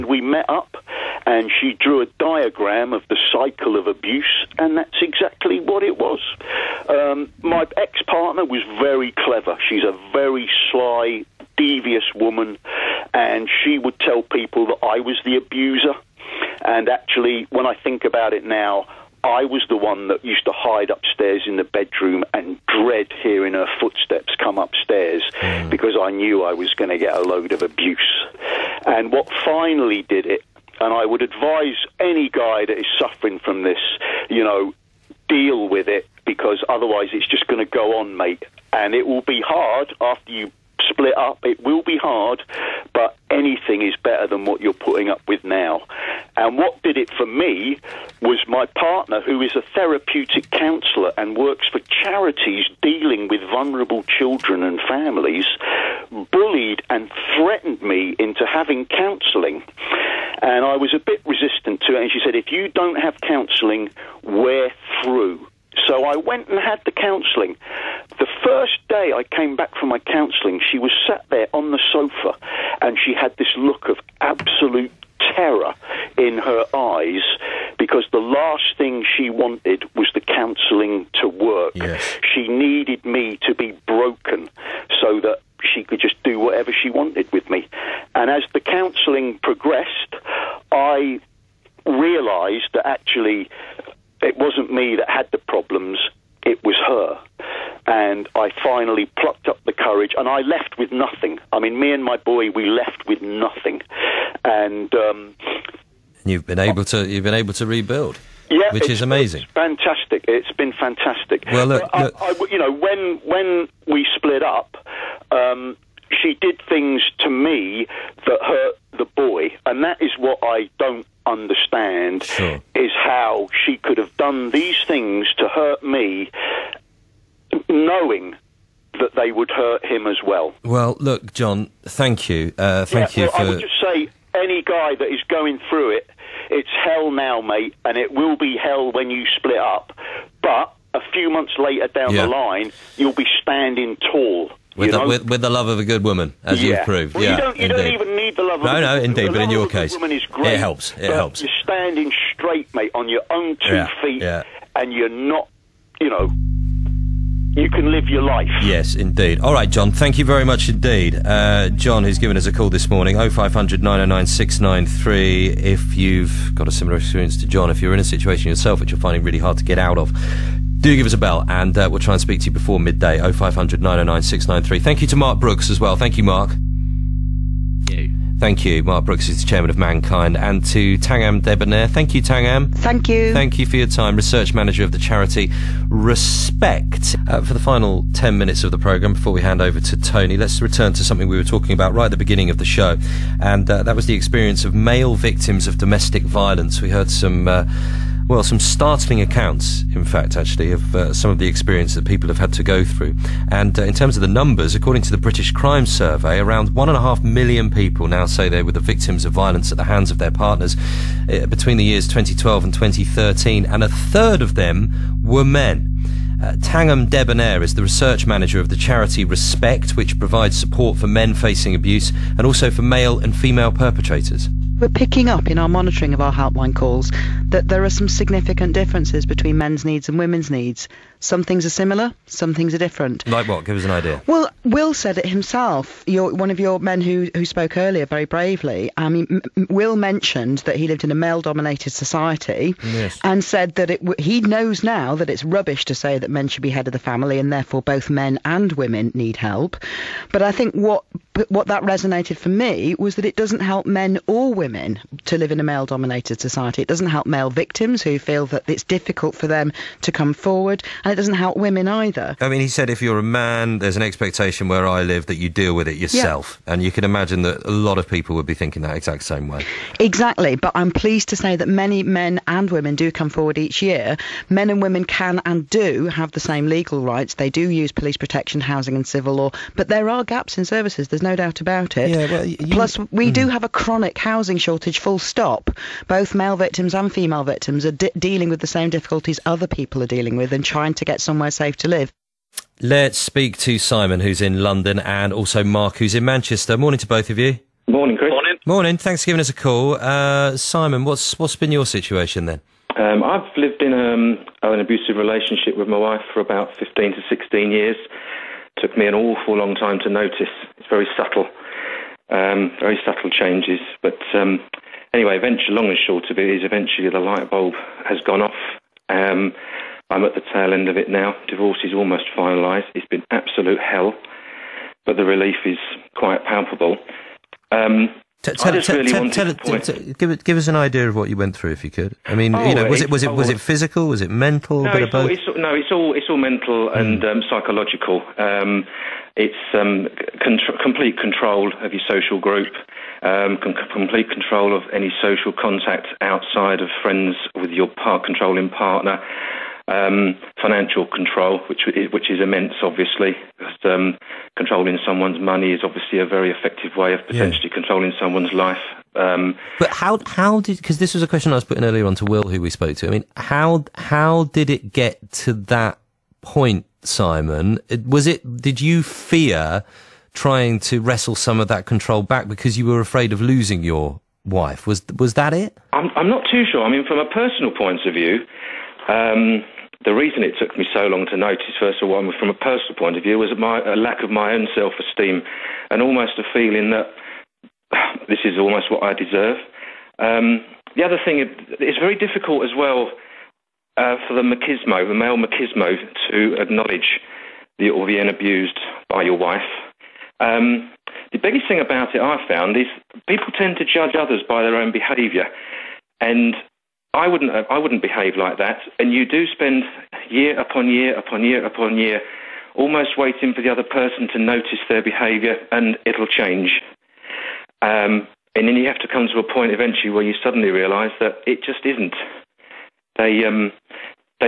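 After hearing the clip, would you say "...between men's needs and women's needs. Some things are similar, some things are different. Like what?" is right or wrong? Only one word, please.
right.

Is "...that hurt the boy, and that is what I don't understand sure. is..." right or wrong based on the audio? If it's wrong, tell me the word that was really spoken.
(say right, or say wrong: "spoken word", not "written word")
right.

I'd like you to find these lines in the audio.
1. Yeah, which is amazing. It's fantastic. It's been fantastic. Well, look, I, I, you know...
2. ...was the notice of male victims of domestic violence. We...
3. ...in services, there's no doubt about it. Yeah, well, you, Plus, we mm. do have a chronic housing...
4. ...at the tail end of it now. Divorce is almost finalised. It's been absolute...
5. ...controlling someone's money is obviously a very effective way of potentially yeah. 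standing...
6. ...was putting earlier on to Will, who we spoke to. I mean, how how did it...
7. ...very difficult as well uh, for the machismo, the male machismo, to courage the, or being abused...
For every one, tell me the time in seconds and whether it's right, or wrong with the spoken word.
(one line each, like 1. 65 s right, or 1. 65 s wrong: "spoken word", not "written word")
1. 108 s right
2. 193 s wrong: "experience", not "notice"
3. 280 s right
4. 320 s right
5. 354 s wrong: "controlling", not "standing"
6. 361 s right
7. 391 s wrong: "acknowledge", not "courage".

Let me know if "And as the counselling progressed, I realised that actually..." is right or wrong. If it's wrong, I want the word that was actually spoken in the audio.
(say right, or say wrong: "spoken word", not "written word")
right.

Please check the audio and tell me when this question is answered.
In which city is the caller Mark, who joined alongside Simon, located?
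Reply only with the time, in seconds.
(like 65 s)
296 s.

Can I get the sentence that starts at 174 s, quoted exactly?
Thank you to Mark Brooks as well.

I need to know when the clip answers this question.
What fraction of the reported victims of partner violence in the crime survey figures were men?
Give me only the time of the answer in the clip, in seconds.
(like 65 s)
213 s.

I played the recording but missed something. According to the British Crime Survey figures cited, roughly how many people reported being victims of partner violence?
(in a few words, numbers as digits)
1.5 million.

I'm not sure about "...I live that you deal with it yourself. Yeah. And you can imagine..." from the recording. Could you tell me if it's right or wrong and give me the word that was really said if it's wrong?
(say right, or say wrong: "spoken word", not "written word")
right.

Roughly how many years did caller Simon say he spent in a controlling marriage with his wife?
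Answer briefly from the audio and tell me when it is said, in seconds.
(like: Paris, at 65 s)
15 to 16 years, at 306 s.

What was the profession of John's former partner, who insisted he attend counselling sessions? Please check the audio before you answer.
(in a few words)
Therapeutic counsellor.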